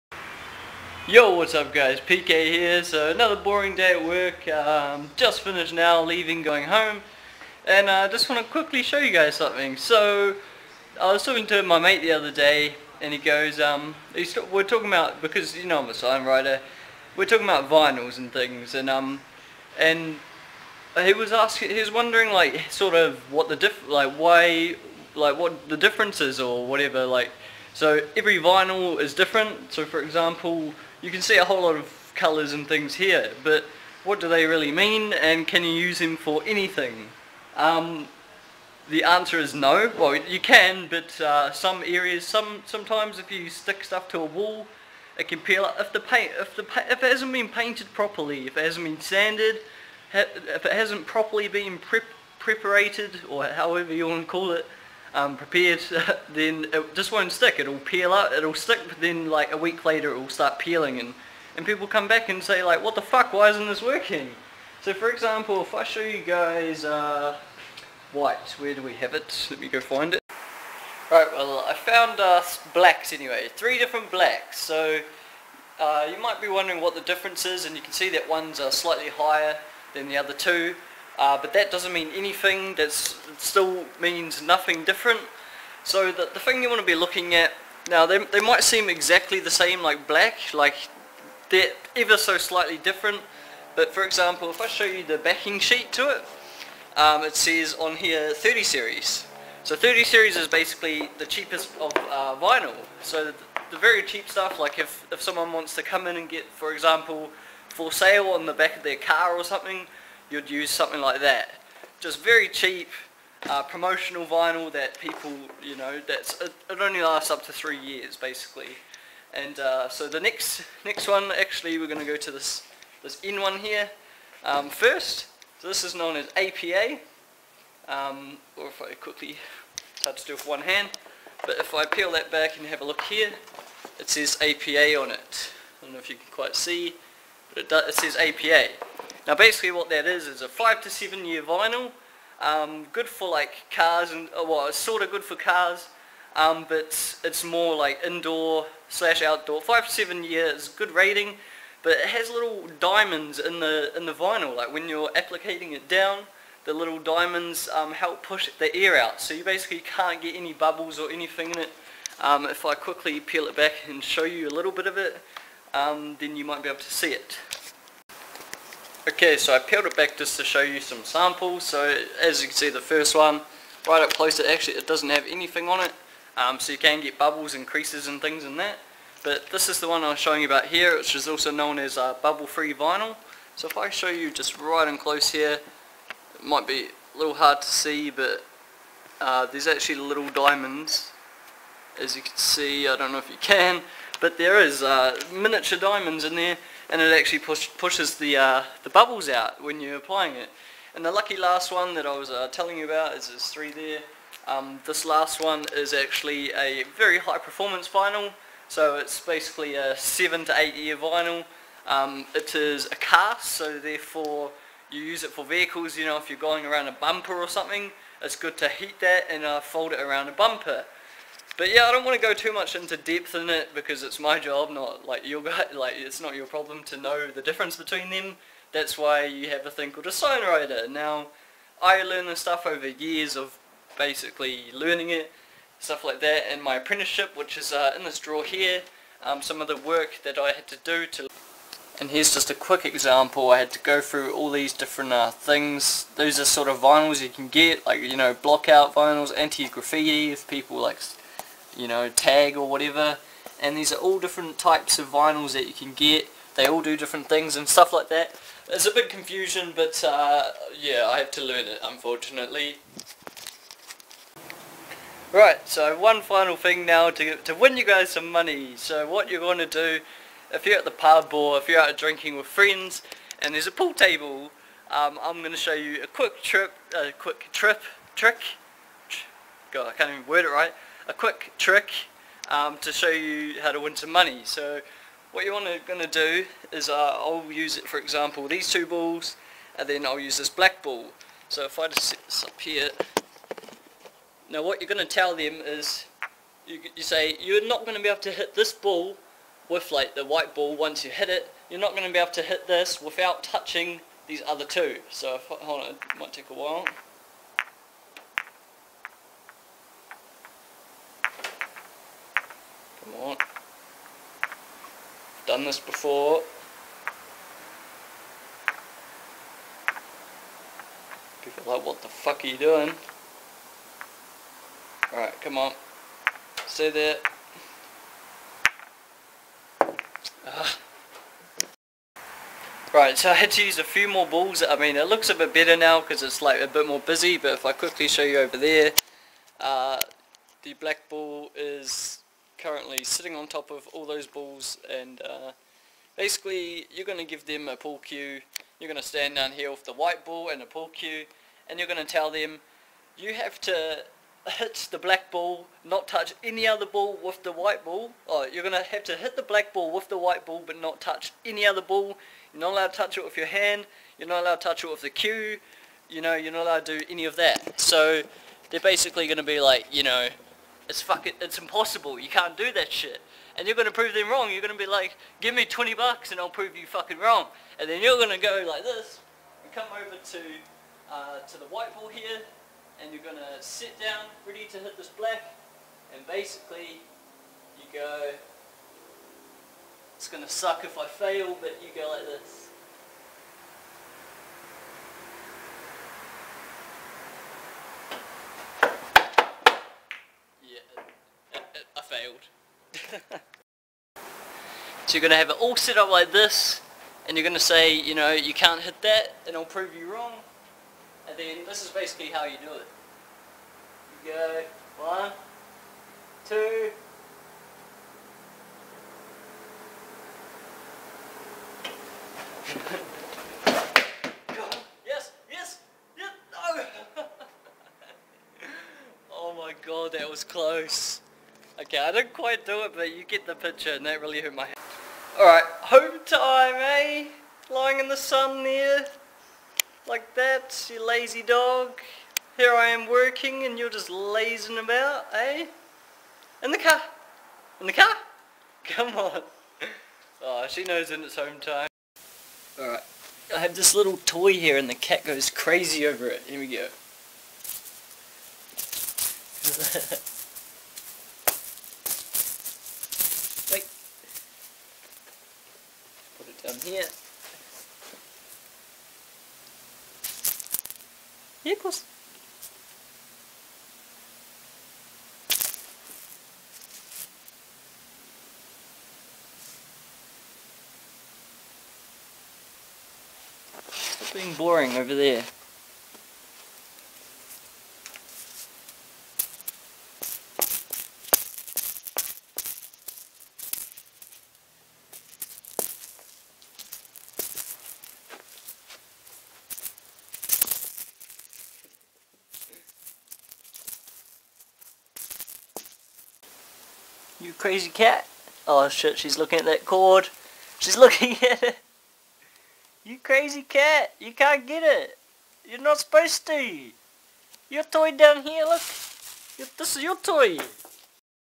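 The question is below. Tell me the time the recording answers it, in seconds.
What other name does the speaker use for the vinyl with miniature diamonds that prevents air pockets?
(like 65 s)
182 s.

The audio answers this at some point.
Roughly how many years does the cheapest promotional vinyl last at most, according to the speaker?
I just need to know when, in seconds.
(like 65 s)
117 s.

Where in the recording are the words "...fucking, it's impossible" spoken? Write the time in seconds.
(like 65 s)
371 s.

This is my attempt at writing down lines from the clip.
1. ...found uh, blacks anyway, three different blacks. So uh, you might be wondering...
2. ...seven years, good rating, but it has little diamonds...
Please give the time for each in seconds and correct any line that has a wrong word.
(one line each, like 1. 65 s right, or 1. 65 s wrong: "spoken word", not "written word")
1. 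71 s right
2. 149 s right.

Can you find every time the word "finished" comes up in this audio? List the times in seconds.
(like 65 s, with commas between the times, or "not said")
5 s.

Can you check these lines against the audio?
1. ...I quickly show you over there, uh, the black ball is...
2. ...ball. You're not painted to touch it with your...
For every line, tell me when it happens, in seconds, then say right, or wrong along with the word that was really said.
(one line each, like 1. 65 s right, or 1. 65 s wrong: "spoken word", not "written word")
1. 337 s right
2. 361 s wrong: "allowed", not "painted".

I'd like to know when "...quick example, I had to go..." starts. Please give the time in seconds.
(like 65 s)
242 s.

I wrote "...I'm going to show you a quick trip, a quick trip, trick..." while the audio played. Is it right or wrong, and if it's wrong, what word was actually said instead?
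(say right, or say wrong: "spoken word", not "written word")
right.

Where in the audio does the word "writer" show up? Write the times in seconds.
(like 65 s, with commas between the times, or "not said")
16 s, 230 s.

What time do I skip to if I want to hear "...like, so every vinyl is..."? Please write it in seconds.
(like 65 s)
27 s.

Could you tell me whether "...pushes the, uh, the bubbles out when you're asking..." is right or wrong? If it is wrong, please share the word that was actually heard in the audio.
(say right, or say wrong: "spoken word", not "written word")
wrong: "applying", not "asking".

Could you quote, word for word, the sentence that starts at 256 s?
They all do different things and stuff like that.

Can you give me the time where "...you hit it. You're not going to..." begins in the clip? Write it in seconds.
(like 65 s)
301 s.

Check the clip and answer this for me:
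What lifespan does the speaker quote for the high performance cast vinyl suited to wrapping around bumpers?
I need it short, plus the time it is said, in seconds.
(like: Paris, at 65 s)
7 to 8 years, at 209 s.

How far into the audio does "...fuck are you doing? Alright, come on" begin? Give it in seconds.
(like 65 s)
322 s.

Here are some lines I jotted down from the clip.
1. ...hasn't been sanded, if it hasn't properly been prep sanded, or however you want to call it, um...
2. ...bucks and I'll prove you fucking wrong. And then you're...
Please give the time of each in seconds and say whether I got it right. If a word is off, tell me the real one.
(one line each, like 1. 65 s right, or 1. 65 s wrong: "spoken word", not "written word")
1. 48 s wrong: "preparated", not "sanded"
2. 375 s right.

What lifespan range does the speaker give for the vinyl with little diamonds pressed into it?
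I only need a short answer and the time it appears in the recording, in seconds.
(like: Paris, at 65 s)
5 to 7 years, at 140 s.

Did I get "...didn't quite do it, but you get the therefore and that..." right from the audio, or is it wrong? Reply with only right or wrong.
wrong.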